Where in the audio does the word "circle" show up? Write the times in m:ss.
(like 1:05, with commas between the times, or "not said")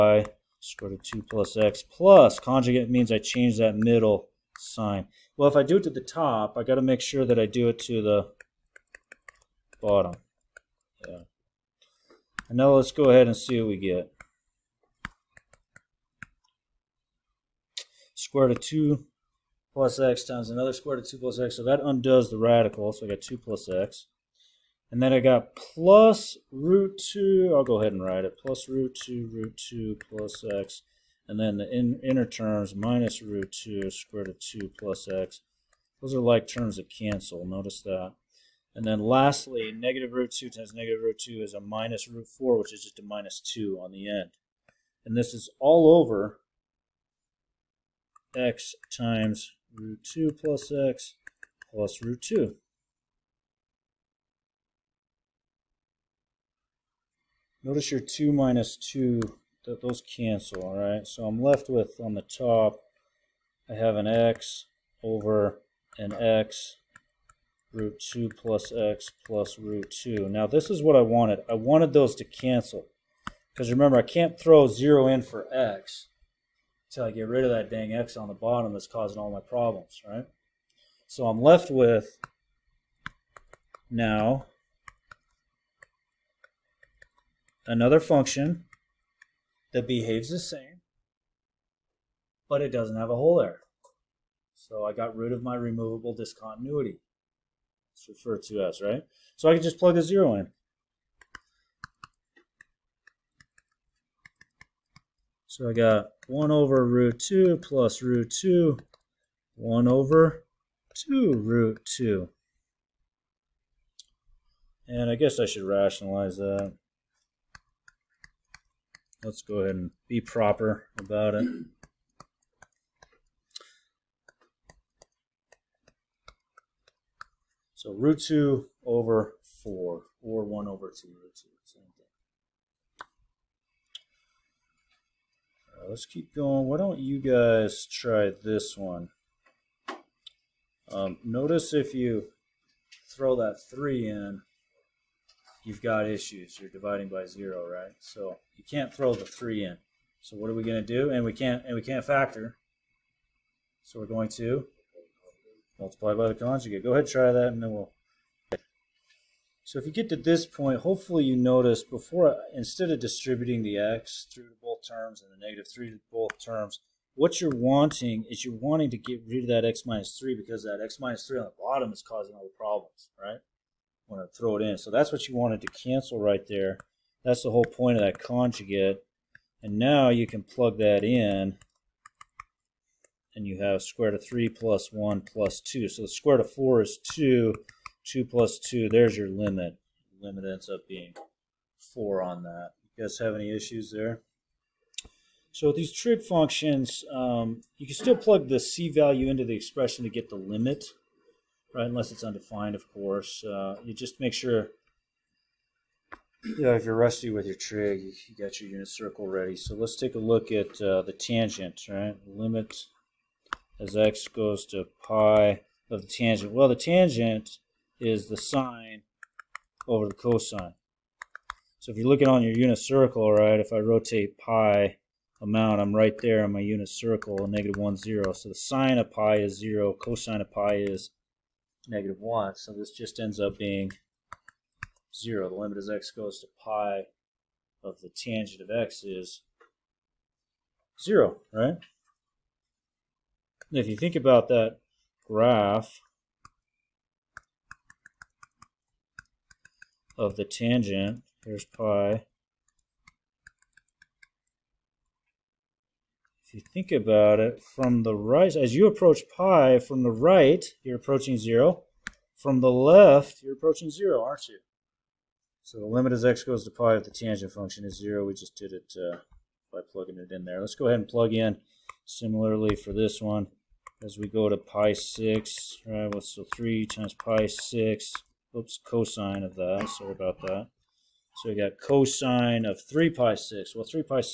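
3:28, 3:42, 3:46.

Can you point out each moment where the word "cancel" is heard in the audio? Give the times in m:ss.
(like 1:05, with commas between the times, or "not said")
0:36, 1:00, 1:12, 2:55.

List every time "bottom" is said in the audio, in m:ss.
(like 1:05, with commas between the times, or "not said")
0:09, 1:18, 2:51.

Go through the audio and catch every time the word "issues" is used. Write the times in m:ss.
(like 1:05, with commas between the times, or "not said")
2:26, 3:13.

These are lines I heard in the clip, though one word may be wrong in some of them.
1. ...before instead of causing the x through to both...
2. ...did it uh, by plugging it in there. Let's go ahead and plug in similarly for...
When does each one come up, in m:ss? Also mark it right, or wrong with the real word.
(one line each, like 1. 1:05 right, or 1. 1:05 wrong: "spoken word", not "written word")
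1. 2:41 wrong: "distributing", not "causing"
2. 4:28 right.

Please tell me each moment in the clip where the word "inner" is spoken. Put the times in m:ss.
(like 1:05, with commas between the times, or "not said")
0:32.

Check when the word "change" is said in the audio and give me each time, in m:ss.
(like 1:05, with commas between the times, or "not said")
0:03.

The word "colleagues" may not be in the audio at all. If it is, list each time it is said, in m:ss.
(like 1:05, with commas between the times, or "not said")
not said.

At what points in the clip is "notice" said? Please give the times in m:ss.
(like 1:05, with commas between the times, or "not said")
0:37, 0:57, 2:21, 2:41.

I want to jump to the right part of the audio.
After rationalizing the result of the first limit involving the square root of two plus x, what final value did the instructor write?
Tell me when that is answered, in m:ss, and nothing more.
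2:07.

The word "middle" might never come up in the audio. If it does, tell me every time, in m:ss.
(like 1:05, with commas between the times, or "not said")
0:03.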